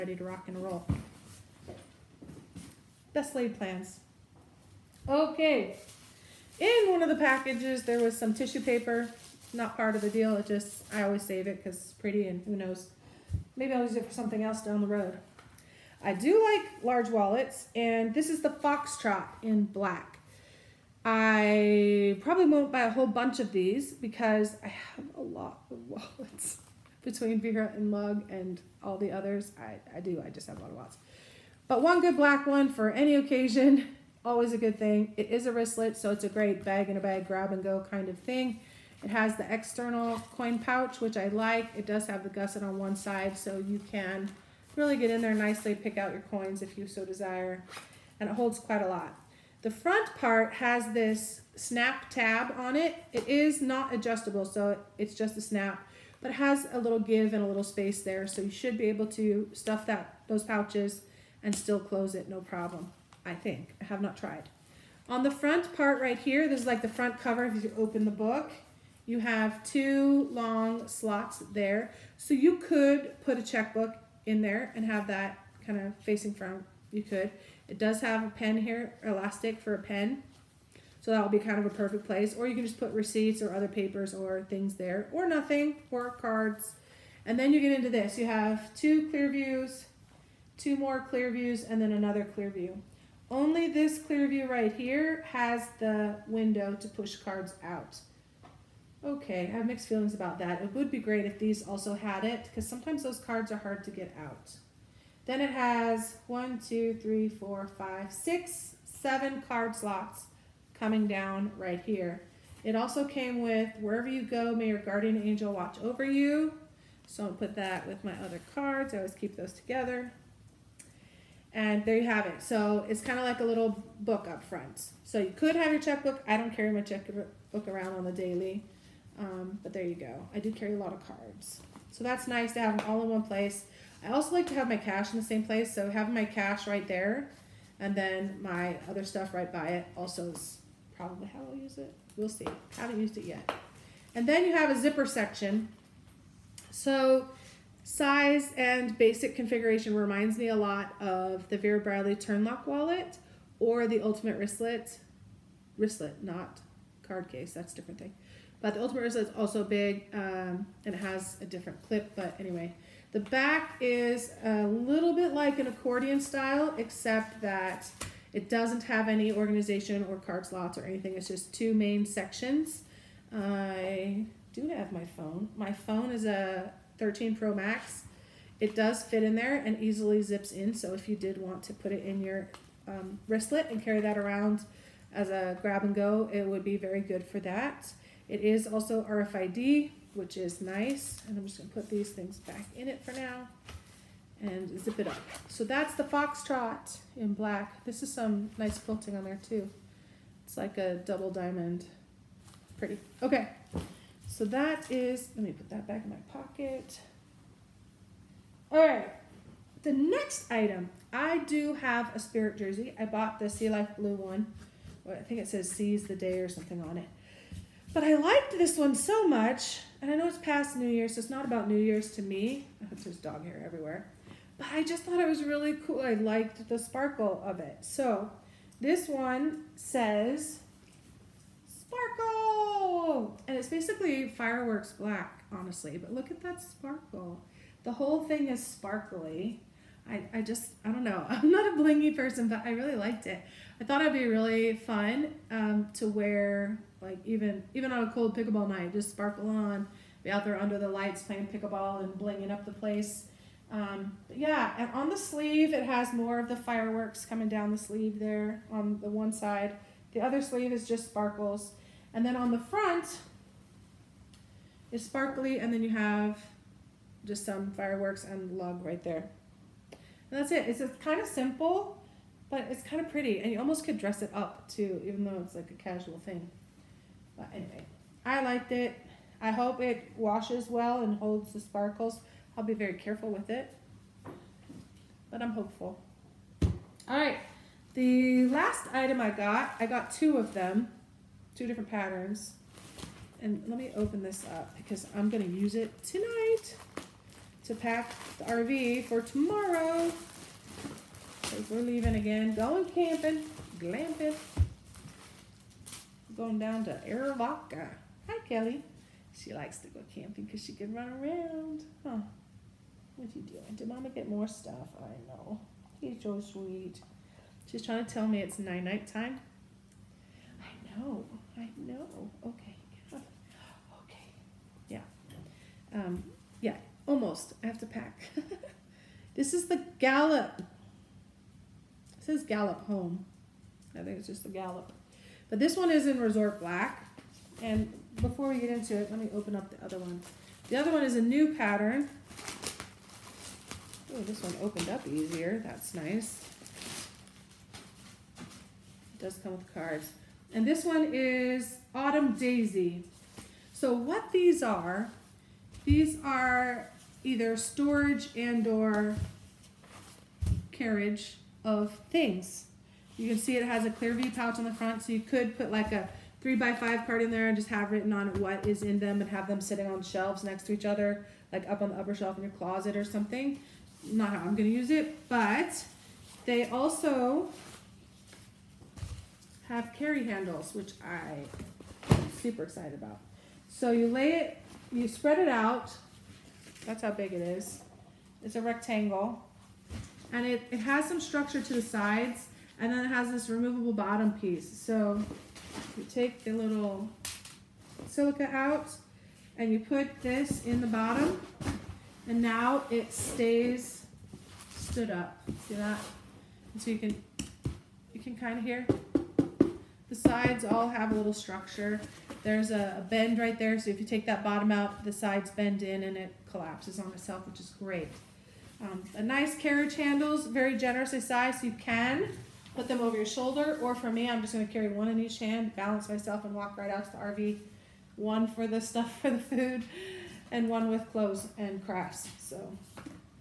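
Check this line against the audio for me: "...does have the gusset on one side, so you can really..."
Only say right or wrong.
right.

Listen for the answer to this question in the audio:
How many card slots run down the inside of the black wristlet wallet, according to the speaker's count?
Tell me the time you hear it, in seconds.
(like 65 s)
108 s.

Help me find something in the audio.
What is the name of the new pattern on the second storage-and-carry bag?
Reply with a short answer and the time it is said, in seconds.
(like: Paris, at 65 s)
Autumn Daisy, at 351 s.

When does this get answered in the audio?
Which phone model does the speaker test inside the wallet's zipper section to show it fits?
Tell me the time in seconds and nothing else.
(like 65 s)
176 s.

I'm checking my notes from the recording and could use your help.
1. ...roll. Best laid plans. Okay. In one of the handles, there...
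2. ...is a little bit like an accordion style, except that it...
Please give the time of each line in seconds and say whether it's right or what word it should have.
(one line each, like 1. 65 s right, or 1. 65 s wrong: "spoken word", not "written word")
1. 0 s wrong: "packages", not "handles"
2. 163 s right.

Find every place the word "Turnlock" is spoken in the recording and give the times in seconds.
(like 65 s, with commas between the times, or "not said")
152 s.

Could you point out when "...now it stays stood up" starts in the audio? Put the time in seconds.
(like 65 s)
402 s.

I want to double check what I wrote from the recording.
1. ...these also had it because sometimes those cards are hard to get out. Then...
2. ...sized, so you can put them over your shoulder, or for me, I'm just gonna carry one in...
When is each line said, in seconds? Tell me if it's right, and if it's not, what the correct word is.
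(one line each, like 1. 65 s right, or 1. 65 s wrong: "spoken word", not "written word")
1. 101 s right
2. 421 s right.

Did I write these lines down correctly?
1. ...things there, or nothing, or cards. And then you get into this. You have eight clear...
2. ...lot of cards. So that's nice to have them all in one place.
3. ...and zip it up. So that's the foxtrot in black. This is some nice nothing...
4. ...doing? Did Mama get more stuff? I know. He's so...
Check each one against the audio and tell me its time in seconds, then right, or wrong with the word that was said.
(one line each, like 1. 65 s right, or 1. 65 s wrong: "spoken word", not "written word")
1. 84 s wrong: "two", not "eight"
2. 130 s right
3. 194 s wrong: "quilting", not "nothing"
4. 313 s right.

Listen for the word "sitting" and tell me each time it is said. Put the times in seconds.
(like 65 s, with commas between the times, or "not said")
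369 s.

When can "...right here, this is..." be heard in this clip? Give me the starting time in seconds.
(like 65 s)
66 s.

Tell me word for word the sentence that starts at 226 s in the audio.
I liked the sparkle of it.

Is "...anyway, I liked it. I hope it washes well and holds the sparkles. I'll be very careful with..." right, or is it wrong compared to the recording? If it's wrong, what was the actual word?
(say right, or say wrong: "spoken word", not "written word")
right.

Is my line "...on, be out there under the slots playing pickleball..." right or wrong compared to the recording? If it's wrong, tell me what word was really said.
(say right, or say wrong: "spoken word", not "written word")
wrong: "lights", not "slots".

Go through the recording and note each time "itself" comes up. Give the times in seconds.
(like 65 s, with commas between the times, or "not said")
417 s.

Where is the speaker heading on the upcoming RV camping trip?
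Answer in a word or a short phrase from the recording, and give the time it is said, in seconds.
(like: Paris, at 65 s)
Aravaca, at 307 s.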